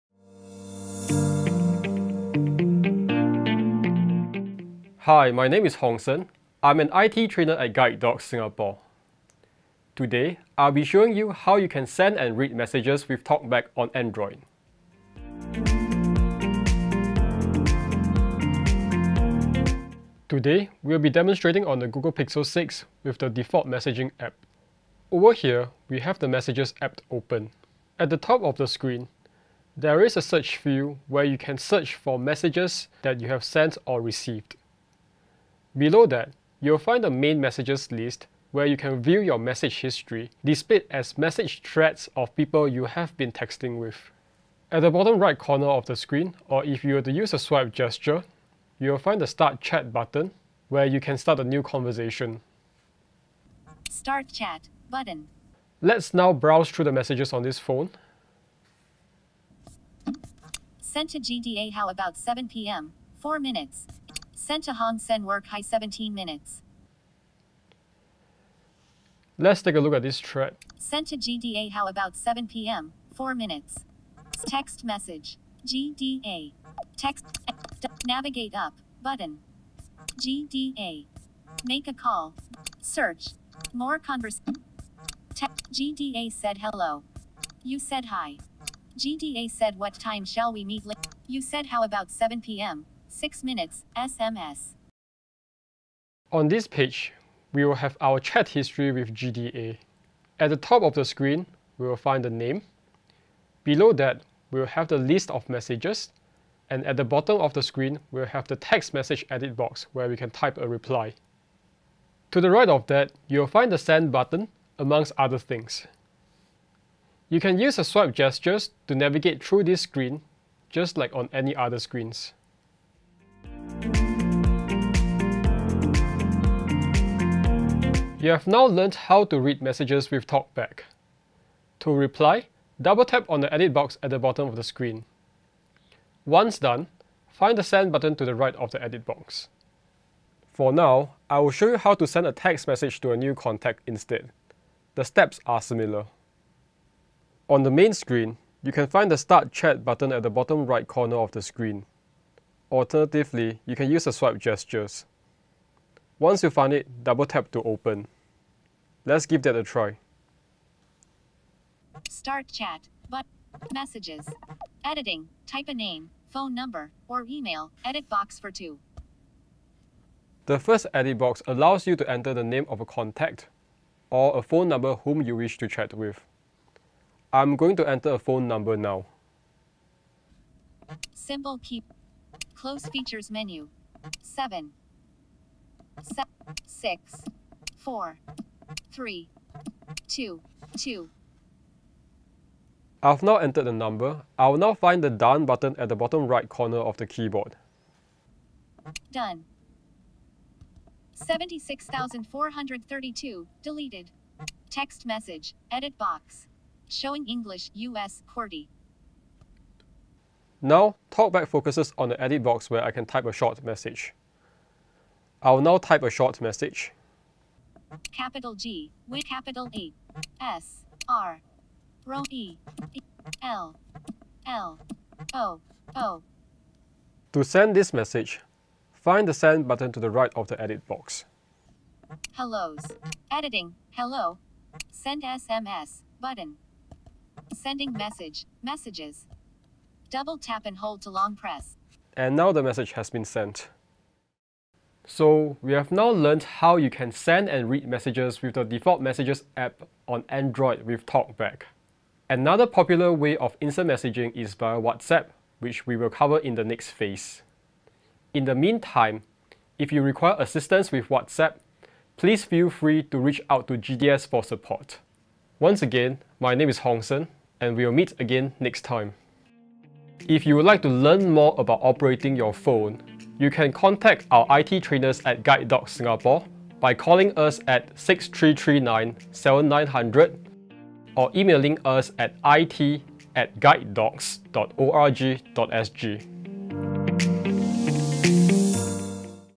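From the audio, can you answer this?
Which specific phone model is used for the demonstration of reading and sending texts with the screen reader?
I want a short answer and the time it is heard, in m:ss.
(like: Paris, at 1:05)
Google Pixel 6, at 0:21.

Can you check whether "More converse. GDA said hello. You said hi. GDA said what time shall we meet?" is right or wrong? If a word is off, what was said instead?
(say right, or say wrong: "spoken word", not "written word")
right.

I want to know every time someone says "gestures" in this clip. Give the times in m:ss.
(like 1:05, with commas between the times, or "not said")
0:47, 1:58, 2:34.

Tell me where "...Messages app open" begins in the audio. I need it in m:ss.
0:26.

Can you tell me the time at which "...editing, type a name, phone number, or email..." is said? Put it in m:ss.
2:44.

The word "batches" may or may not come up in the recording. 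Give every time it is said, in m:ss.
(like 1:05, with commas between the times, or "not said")
not said.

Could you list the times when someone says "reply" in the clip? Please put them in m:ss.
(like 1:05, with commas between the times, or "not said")
1:50, 2:11.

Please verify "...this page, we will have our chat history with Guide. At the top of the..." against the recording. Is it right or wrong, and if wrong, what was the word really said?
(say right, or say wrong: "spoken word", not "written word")
wrong: "GDA", not "Guide".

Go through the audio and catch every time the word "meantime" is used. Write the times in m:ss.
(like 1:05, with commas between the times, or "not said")
4:18.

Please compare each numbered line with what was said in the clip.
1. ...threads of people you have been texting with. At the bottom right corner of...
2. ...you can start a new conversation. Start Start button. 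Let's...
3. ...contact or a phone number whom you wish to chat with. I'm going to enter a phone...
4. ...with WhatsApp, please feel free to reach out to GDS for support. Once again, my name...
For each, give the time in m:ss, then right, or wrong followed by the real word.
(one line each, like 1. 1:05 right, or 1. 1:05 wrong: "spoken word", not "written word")
1. 0:41 right
2. 0:50 wrong: "Chat", not "Start"
3. 2:52 right
4. 4:20 right.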